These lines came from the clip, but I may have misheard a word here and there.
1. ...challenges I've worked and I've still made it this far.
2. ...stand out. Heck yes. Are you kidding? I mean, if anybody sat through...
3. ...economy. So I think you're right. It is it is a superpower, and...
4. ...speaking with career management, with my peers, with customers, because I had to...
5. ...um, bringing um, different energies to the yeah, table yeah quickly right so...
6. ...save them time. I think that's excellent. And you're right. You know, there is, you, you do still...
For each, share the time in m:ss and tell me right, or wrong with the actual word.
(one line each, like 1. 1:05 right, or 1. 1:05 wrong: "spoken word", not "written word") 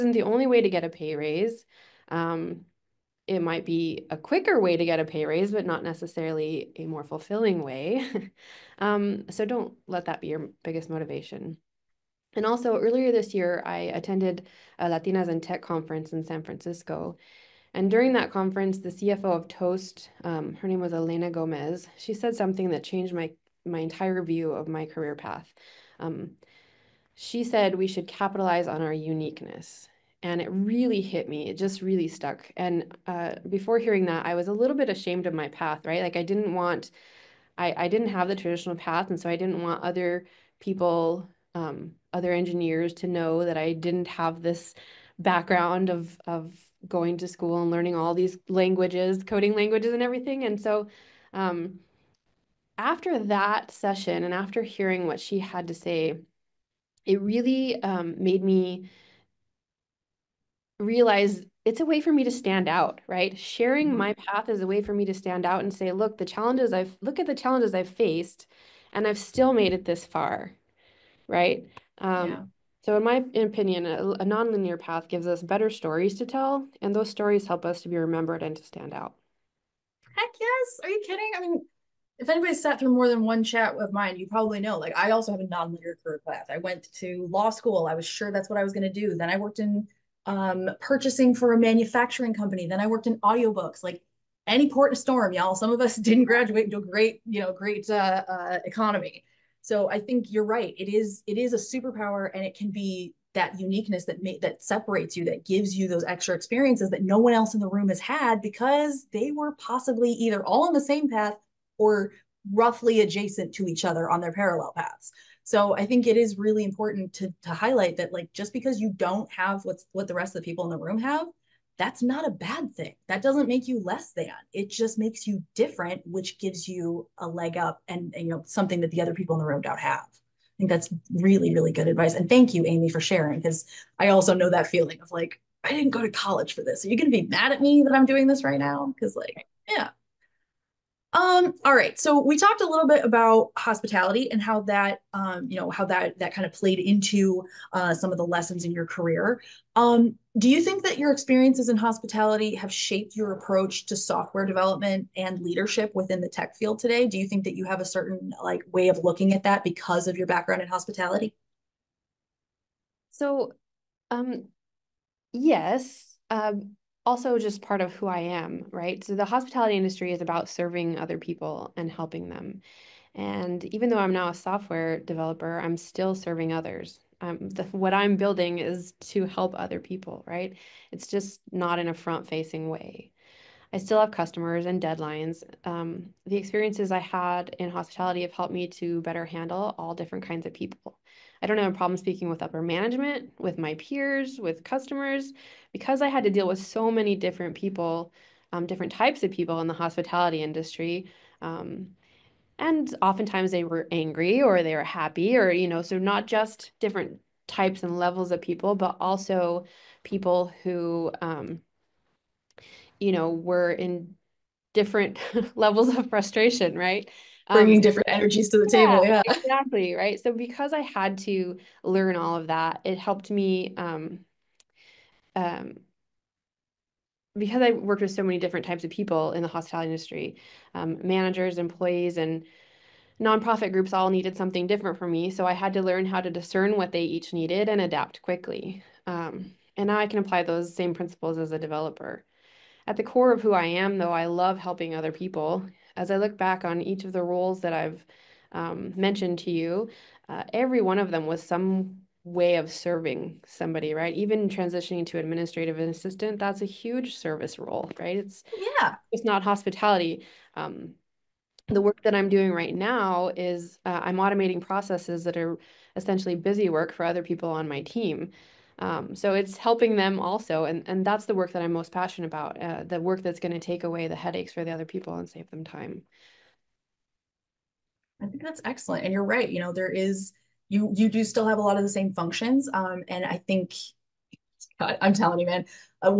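1. 1:07 wrong: "faced", not "worked"
2. 1:18 right
3. 1:38 right
4. 3:11 wrong: "upper", not "career"
5. 3:37 wrong: "exactly", not "quickly"
6. 4:35 right.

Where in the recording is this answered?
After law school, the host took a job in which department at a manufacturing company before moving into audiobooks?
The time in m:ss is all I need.
1:30.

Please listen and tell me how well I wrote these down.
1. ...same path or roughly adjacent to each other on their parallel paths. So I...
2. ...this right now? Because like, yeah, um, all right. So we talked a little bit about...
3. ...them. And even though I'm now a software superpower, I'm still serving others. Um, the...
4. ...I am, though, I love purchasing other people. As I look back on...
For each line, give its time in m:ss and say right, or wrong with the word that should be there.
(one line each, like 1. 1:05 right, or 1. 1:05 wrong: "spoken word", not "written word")
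1. 1:50 right
2. 2:18 right
3. 2:52 wrong: "developer", not "superpower"
4. 4:03 wrong: "helping", not "purchasing".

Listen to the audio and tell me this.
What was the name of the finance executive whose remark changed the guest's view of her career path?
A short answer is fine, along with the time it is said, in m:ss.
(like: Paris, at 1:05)
Elena Gomez, at 0:20.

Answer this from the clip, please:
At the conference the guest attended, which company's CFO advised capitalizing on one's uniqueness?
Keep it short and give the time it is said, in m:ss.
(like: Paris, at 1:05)
Toast, at 0:19.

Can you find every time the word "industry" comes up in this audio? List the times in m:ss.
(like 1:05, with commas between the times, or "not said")
2:49, 3:20, 3:49.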